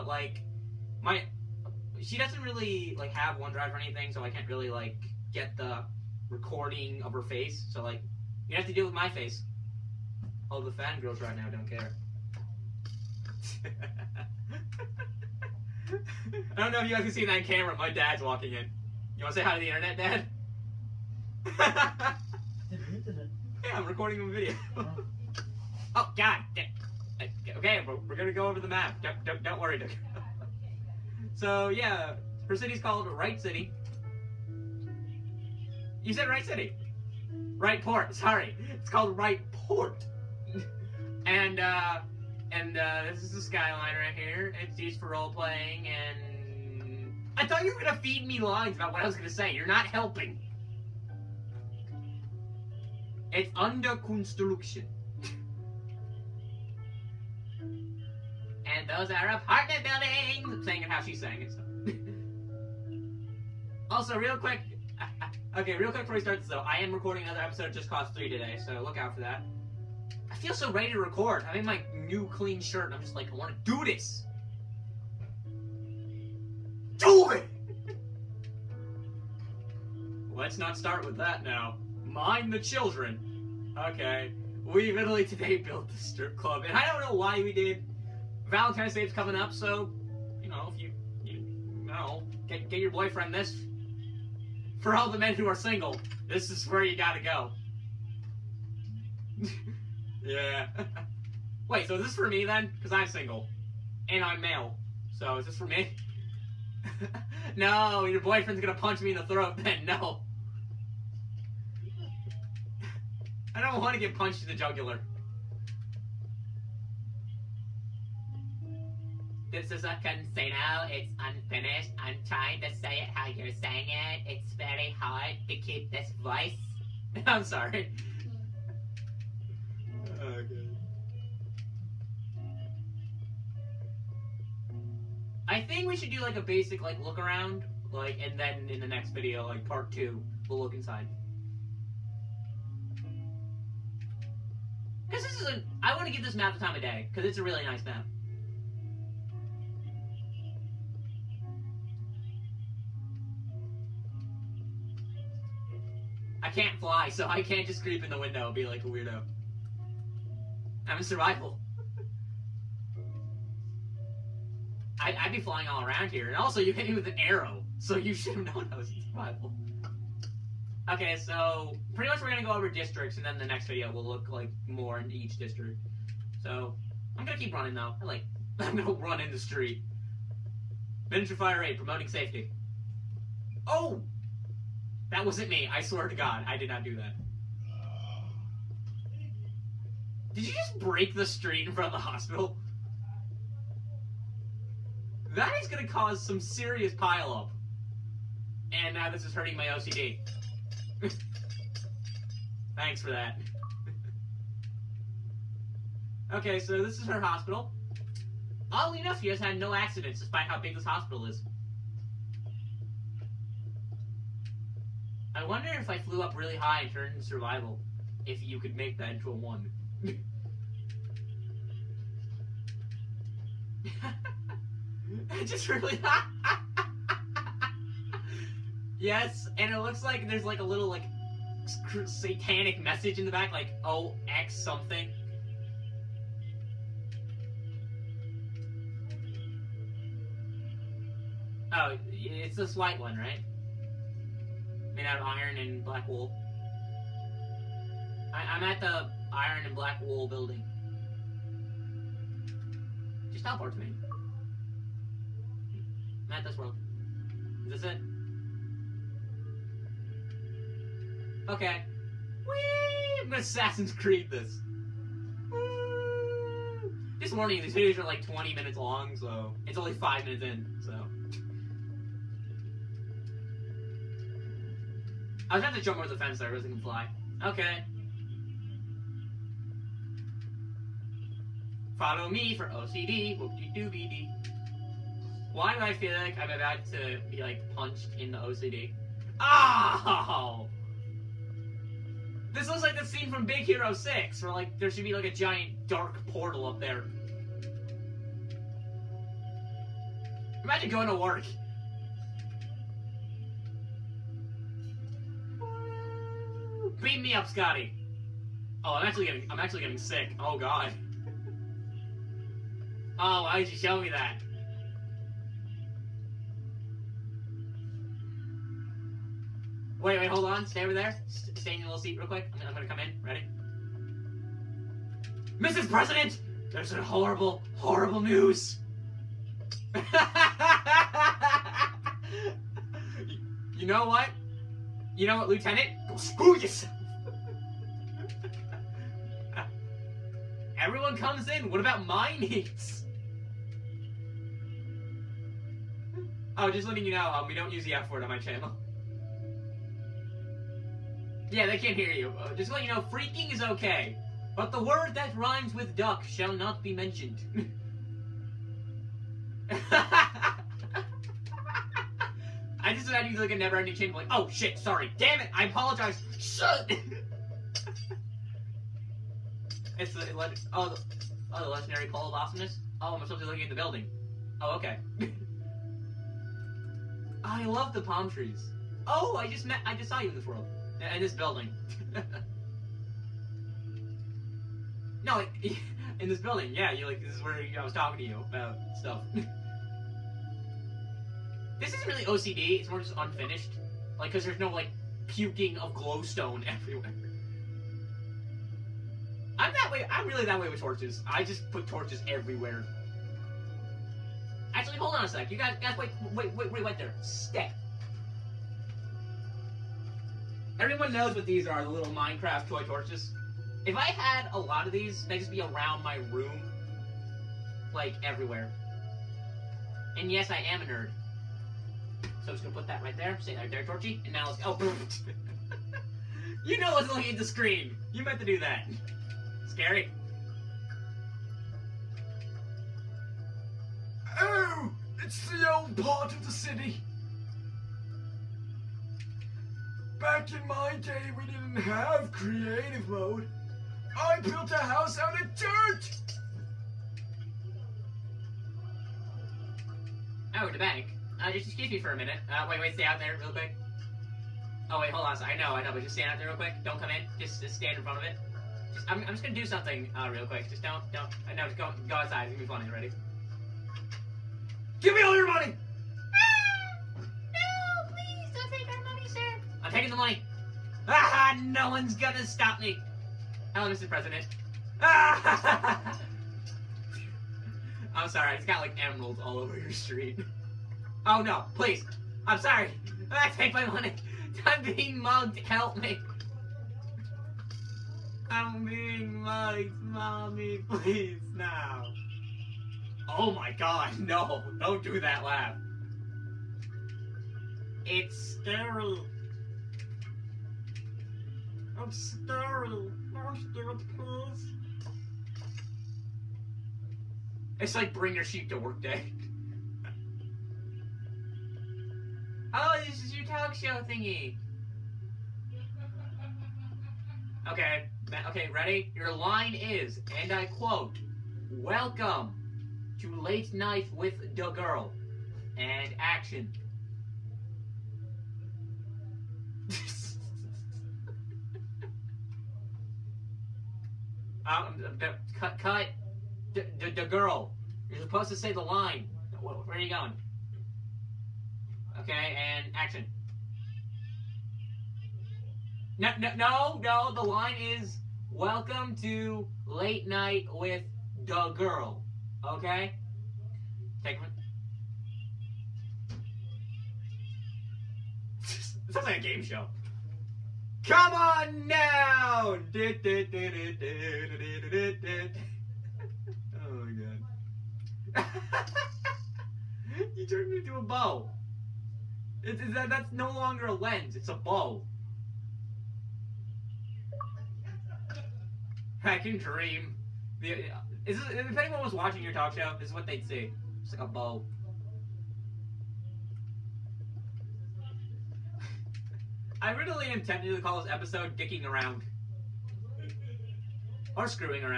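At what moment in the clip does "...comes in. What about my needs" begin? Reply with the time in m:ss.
5:41.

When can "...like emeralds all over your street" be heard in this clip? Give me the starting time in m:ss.
7:58.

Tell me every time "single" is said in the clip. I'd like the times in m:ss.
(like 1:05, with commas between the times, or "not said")
1:35, 1:43.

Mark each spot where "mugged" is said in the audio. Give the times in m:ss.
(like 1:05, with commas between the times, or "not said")
8:05, 8:09.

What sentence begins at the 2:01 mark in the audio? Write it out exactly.
I'm trying to say it how you're saying it.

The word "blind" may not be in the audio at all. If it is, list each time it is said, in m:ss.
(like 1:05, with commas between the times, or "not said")
not said.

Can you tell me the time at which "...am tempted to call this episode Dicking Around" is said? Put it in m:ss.
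9:50.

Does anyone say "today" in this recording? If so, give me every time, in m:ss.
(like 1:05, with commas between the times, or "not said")
1:08, 1:25.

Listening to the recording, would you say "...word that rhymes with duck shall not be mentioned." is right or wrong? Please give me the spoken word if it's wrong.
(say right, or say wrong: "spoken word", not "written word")
right.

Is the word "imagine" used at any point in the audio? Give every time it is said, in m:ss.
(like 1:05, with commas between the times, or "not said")
5:00, 6:03.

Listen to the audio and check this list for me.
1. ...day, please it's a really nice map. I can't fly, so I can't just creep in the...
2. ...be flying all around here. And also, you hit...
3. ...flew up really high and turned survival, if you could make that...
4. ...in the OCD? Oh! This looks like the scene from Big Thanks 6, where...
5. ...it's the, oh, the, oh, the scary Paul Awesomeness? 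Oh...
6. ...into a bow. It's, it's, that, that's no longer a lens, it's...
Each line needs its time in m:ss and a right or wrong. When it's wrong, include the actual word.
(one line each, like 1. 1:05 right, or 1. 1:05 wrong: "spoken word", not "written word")
1. 2:26 wrong: "cause", not "please"
2. 2:45 right
3. 3:35 right
4. 4:48 wrong: "Hero", not "Thanks"
5. 6:09 wrong: "legendary", not "scary"
6. 9:30 right.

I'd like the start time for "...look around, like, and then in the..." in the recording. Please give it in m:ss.
2:17.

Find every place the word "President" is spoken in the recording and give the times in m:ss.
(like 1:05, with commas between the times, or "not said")
5:25, 7:54.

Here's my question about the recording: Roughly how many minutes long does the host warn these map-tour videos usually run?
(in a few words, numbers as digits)
20 minutes.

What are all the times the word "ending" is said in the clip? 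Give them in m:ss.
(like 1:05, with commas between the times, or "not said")
6:03.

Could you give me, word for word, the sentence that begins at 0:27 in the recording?
Okay, we're, going to go over the map.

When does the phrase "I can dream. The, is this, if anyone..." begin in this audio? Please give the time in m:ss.
9:39.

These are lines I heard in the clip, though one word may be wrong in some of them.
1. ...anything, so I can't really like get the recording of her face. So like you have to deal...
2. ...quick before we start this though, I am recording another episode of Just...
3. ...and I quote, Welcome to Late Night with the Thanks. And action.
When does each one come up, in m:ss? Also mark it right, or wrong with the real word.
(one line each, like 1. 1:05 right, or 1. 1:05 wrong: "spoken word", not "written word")
1. 0:03 right
2. 1:05 right
3. 8:40 wrong: "Girl", not "Thanks".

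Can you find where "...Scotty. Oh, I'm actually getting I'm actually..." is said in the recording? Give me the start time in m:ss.
5:07.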